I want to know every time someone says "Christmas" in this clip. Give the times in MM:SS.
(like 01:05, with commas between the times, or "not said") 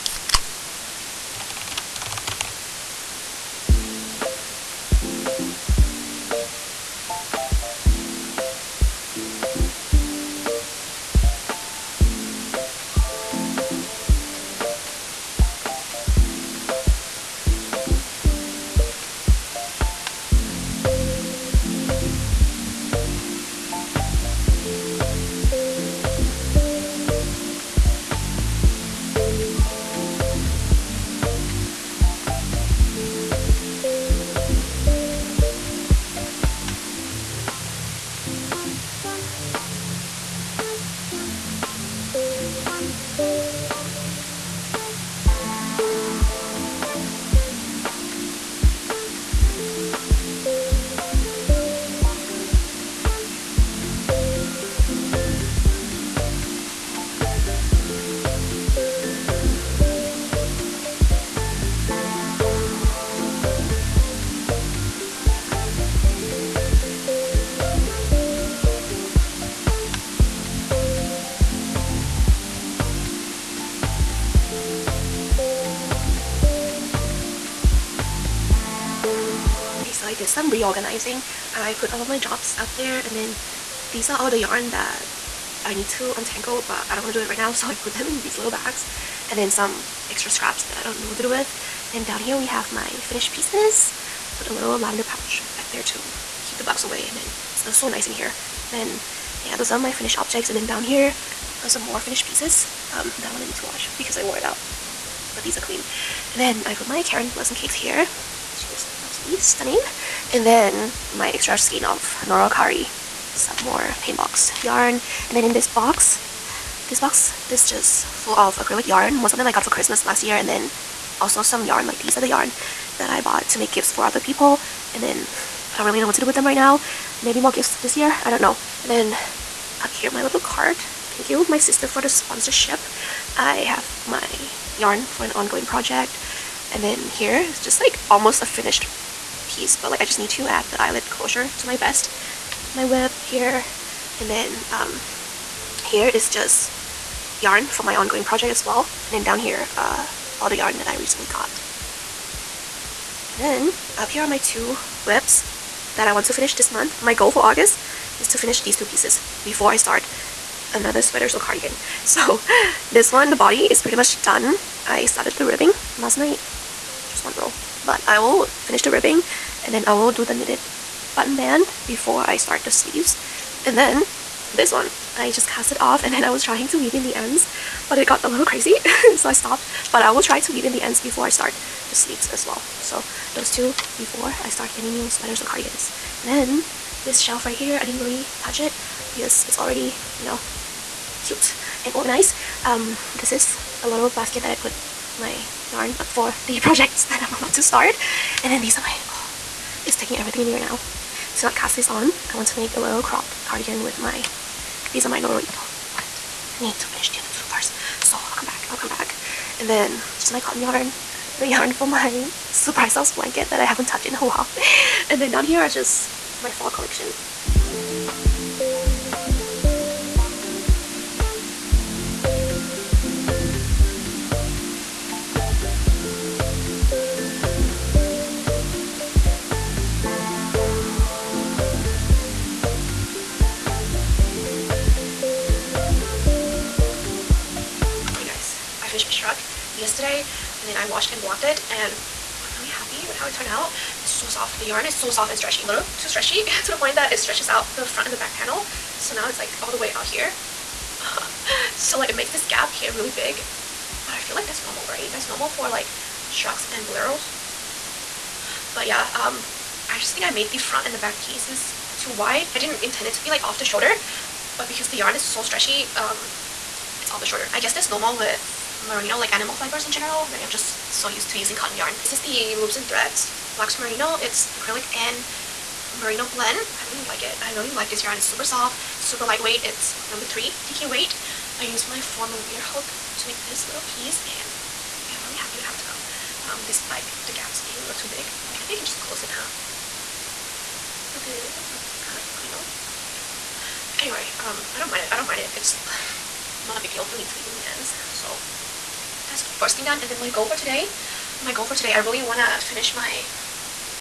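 01:59.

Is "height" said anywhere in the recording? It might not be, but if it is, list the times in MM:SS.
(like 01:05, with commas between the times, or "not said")
not said.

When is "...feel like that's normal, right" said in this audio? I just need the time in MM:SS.
04:14.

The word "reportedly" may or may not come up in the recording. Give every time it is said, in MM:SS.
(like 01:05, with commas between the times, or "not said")
not said.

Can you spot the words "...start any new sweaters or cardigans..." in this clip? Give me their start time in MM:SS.
03:04.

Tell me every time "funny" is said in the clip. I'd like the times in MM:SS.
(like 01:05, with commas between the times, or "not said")
04:52.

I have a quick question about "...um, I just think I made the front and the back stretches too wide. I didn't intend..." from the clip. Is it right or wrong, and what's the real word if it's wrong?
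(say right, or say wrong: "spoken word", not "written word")
wrong: "pieces", not "stretches".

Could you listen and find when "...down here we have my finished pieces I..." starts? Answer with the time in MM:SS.
01:32.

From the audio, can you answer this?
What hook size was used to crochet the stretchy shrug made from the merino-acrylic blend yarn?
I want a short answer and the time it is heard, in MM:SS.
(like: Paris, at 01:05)
4 millimeter, at 04:41.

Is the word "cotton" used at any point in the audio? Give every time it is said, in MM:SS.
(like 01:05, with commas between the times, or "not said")
03:30, 04:31.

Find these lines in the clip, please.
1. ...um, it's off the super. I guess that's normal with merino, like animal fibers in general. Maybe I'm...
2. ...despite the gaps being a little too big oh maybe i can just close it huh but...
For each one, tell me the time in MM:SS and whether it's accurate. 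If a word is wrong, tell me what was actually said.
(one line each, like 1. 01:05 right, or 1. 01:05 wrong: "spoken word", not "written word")
1. 04:25 wrong: "shoulder", not "super"
2. 04:46 right.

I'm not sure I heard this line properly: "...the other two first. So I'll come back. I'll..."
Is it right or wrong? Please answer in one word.
right.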